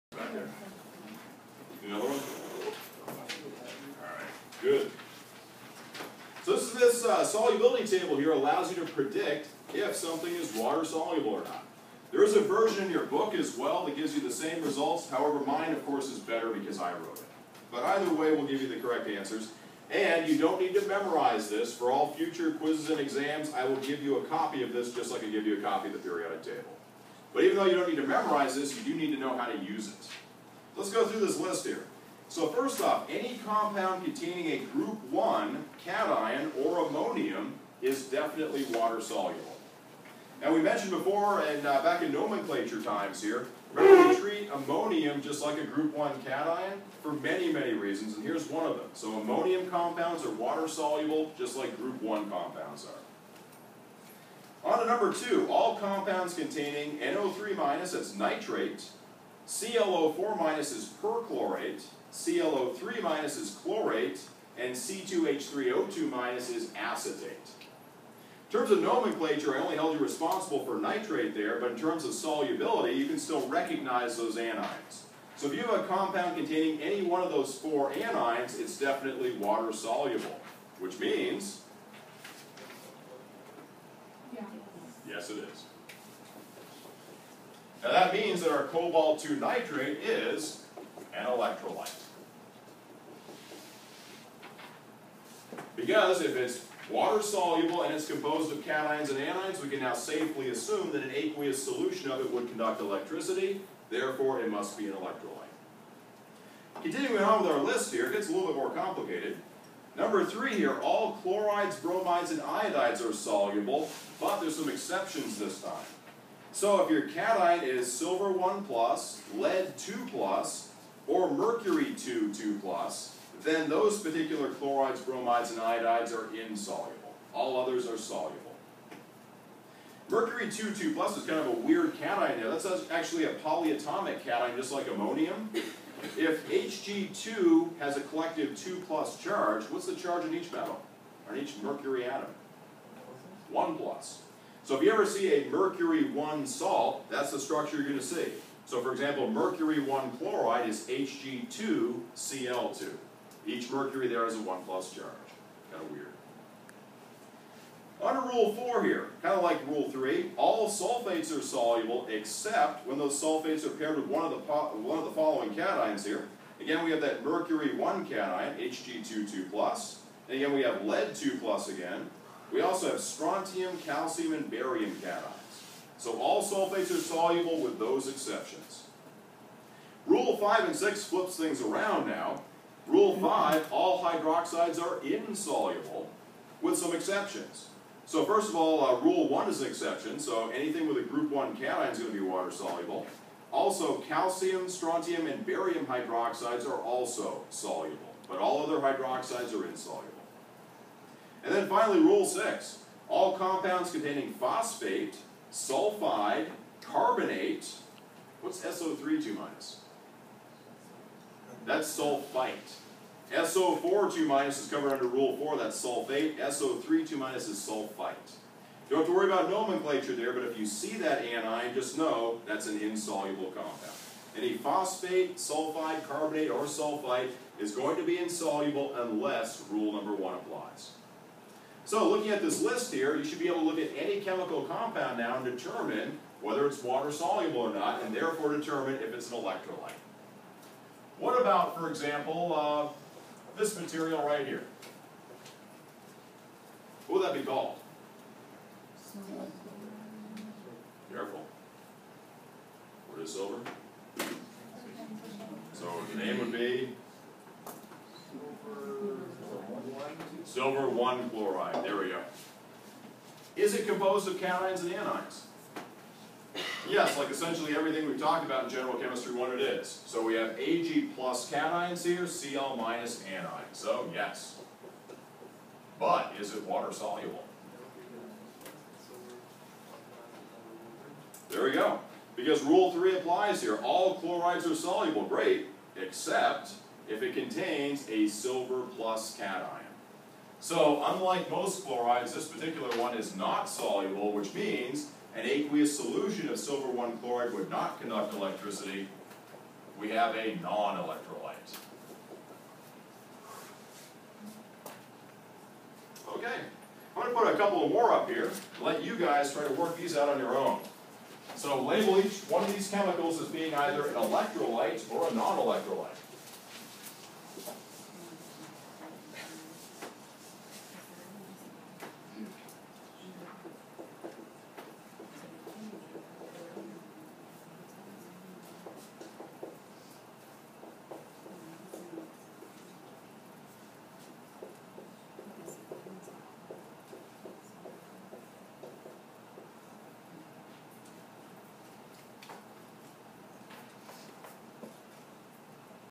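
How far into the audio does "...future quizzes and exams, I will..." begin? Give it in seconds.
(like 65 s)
22 s.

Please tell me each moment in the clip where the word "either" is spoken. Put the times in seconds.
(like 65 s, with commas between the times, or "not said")
17 s, 313 s.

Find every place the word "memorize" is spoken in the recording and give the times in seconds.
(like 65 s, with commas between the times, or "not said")
20 s, 28 s.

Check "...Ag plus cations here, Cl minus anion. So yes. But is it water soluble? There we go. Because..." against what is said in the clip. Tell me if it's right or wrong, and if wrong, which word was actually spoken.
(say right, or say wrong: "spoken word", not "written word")
right.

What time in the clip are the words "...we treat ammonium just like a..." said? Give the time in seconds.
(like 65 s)
44 s.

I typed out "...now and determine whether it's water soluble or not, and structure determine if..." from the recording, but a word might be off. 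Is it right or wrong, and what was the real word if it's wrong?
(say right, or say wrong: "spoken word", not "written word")
wrong: "therefore", not "structure".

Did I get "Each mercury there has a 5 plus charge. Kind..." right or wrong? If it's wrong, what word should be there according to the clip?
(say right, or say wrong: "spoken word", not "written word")
wrong: "1", not "5".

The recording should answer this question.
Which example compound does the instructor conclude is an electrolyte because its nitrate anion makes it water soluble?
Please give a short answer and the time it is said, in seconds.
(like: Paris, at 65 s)
Cobalt 2 nitrate, at 88 s.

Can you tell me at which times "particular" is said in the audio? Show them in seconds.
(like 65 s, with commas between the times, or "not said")
123 s, 292 s.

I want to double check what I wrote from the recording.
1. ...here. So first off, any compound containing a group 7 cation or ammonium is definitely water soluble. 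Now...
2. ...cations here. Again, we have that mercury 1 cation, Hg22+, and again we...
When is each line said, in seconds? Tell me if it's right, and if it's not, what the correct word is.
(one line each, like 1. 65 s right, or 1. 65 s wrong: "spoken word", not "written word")
1. 31 s wrong: "1", not "7"
2. 165 s right.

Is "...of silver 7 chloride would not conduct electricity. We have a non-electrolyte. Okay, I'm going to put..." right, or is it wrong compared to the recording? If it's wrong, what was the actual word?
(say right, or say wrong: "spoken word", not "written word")
wrong: "1", not "7".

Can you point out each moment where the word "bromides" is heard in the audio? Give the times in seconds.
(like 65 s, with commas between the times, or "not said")
111 s, 125 s.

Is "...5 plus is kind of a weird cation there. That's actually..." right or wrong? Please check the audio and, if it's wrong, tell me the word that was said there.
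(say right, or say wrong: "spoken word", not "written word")
wrong: "2", not "5".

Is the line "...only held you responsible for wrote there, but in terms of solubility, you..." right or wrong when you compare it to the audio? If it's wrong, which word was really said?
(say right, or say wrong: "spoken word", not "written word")
wrong: "nitrate", not "wrote".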